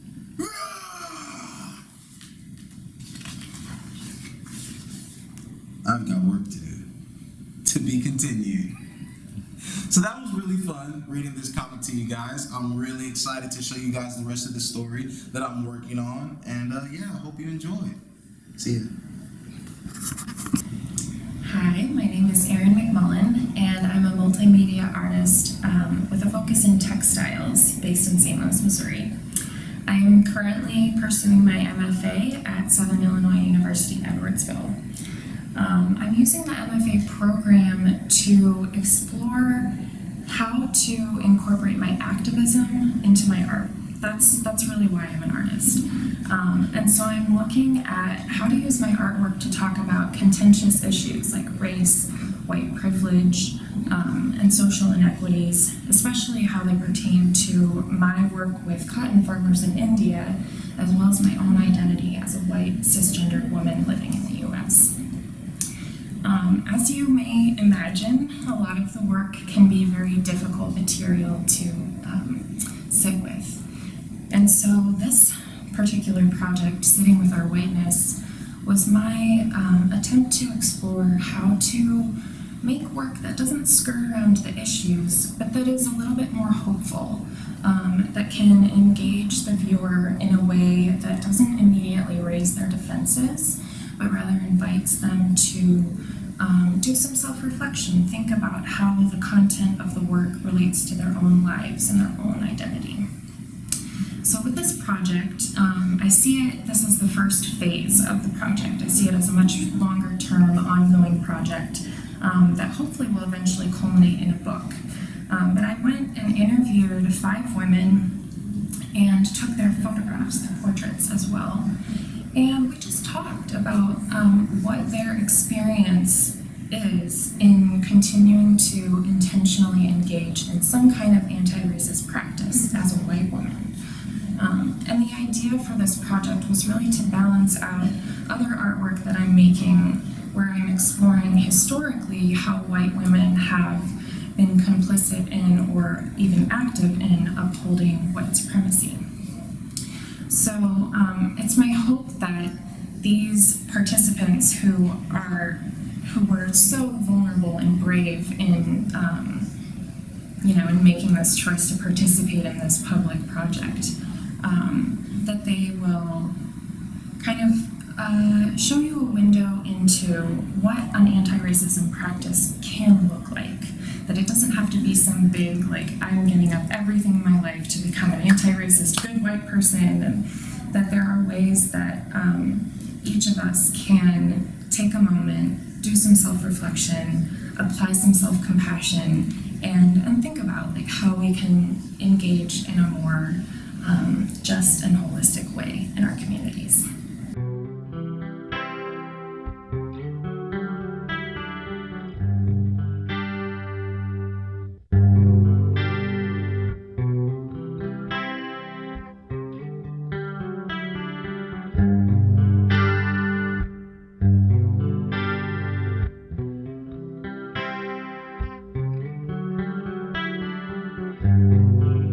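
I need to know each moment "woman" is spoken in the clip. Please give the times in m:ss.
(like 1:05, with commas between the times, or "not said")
1:03, 2:13.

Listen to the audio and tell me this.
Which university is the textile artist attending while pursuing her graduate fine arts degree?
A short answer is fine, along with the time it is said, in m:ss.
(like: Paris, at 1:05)
Southern Illinois University Edwardsville, at 0:32.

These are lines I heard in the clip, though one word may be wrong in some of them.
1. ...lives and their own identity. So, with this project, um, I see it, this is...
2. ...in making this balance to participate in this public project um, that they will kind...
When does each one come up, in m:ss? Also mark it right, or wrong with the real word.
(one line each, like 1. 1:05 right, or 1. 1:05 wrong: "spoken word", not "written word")
1. 1:41 right
2. 2:40 wrong: "choice", not "balance".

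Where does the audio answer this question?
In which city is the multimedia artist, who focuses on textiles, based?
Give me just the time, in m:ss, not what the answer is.
0:28.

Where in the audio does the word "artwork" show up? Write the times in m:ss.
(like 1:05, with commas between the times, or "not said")
0:48, 2:18.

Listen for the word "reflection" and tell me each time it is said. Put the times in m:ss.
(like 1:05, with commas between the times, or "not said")
1:37, 3:06.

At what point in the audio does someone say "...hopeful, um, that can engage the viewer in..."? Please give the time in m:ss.
1:26.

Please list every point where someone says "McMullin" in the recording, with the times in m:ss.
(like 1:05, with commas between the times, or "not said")
0:22.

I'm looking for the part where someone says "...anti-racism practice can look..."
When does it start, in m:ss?
2:51.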